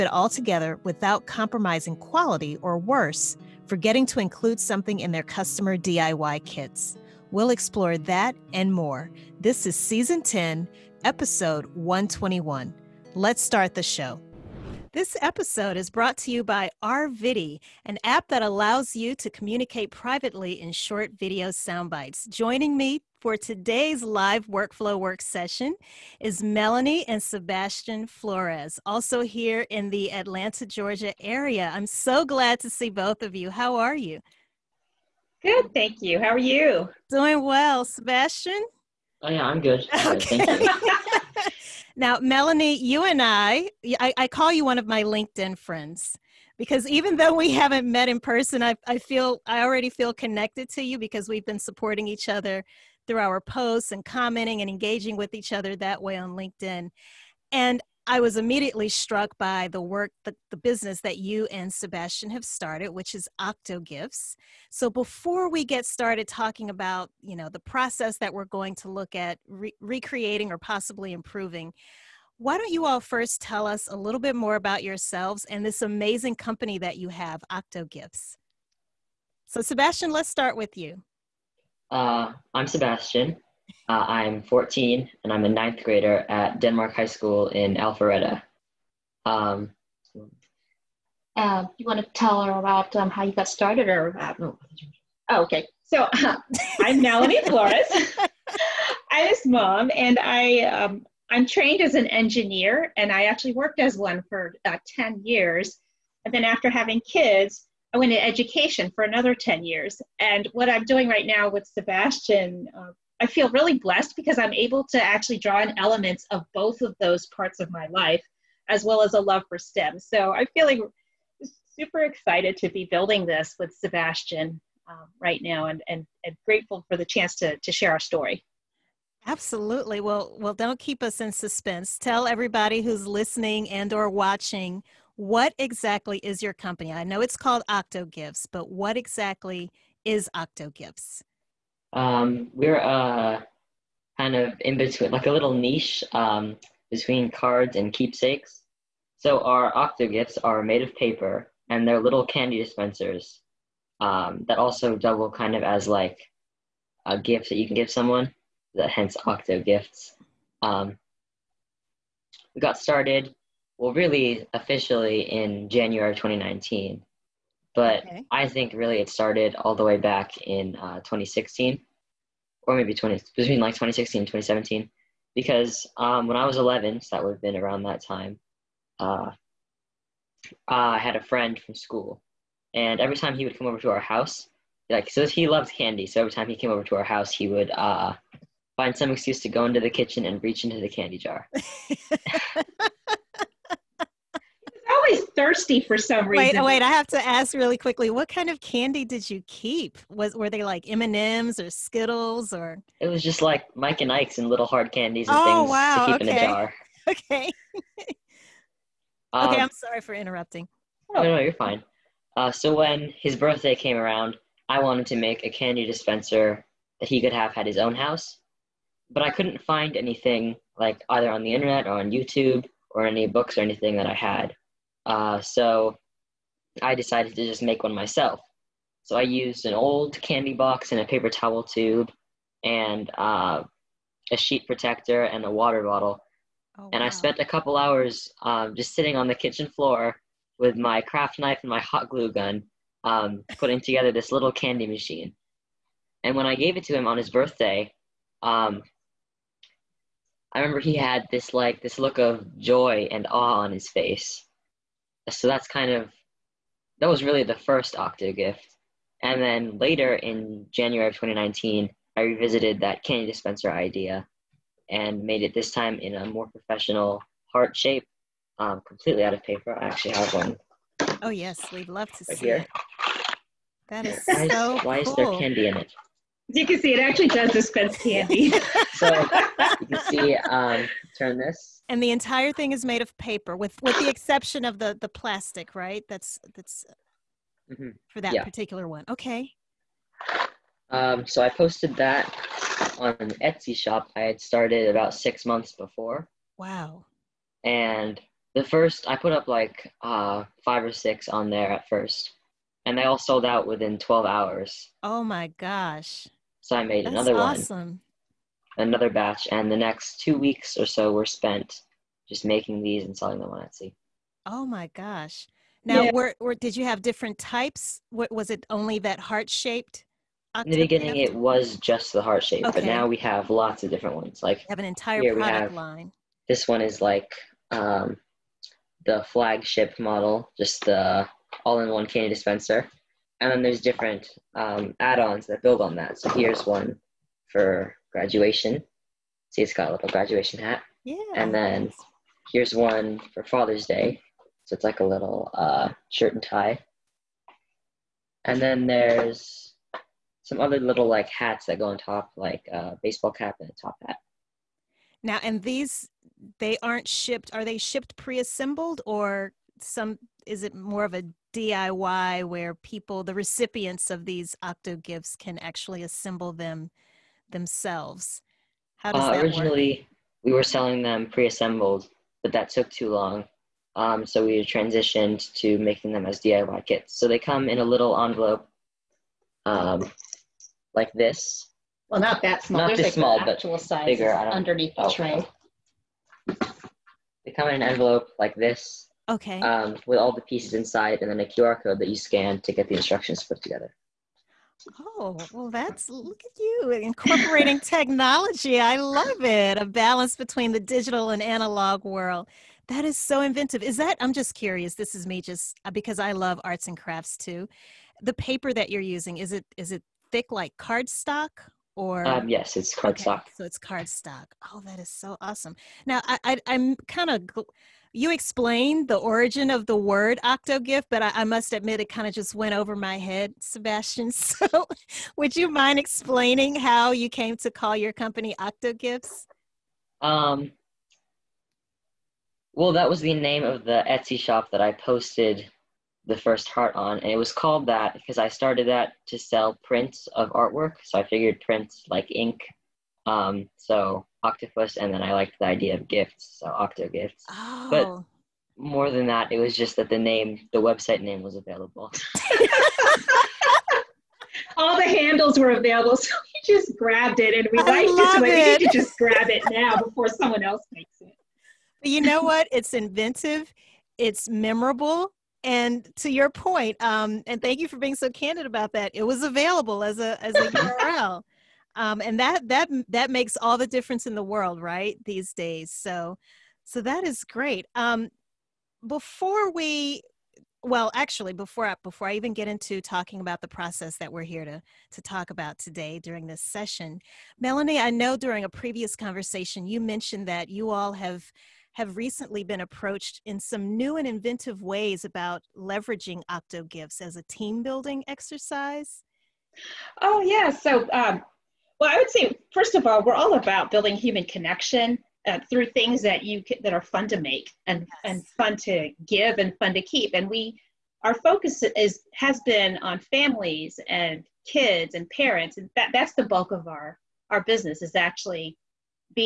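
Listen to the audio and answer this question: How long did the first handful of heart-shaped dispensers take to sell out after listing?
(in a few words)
12 hours.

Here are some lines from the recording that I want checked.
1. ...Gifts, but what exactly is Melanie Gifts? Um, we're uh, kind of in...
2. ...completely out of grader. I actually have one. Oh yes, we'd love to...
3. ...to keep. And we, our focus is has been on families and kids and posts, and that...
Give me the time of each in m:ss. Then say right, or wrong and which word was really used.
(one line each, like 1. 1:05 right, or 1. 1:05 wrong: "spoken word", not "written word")
1. 2:18 wrong: "Octo", not "Melanie"
2. 4:28 wrong: "paper", not "grader"
3. 8:29 wrong: "parents", not "posts".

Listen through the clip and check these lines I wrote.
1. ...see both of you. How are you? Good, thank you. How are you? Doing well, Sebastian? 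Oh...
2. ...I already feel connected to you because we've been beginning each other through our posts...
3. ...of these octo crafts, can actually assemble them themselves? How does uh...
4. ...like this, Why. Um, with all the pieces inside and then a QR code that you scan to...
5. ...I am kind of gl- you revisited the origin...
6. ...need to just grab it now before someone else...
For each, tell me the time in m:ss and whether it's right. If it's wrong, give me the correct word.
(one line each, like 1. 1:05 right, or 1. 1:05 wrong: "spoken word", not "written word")
1. 0:32 right
2. 0:49 wrong: "supporting", not "beginning"
3. 6:04 wrong: "gifts", not "crafts"
4. 6:28 wrong: "Okay", not "Why"
5. 6:56 wrong: "explained", not "revisited"
6. 7:38 right.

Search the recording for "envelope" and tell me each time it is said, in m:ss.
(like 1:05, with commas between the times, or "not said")
6:18, 6:27.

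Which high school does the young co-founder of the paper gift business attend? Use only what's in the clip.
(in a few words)
Denmark High School.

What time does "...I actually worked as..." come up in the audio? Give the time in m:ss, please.
1:43.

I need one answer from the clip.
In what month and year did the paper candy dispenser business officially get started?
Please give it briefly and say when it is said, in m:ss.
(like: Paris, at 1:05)
January 2019, at 2:45.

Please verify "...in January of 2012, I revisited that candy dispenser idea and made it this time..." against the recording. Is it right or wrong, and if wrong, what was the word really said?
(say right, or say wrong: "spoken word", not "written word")
wrong: "2019", not "2012".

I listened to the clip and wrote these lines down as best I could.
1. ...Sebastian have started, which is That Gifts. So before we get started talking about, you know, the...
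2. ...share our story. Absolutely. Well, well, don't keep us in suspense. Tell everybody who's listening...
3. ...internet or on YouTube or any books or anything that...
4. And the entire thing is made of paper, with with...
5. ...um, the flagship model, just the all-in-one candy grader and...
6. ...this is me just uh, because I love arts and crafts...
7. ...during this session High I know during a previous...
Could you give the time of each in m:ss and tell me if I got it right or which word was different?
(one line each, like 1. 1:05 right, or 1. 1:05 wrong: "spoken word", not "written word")
1. 1:01 wrong: "Octo", not "That"
2. 2:07 right
3. 3:41 right
4. 4:41 right
5. 5:27 wrong: "dispenser", not "grader"
6. 6:44 right
7. 8:06 wrong: "Melanie", not "High".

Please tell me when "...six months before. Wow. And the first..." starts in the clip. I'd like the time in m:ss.
4:55.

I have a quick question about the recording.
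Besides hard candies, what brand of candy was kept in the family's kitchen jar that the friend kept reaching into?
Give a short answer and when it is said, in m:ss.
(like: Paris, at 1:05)
Mike and Ike's, at 3:23.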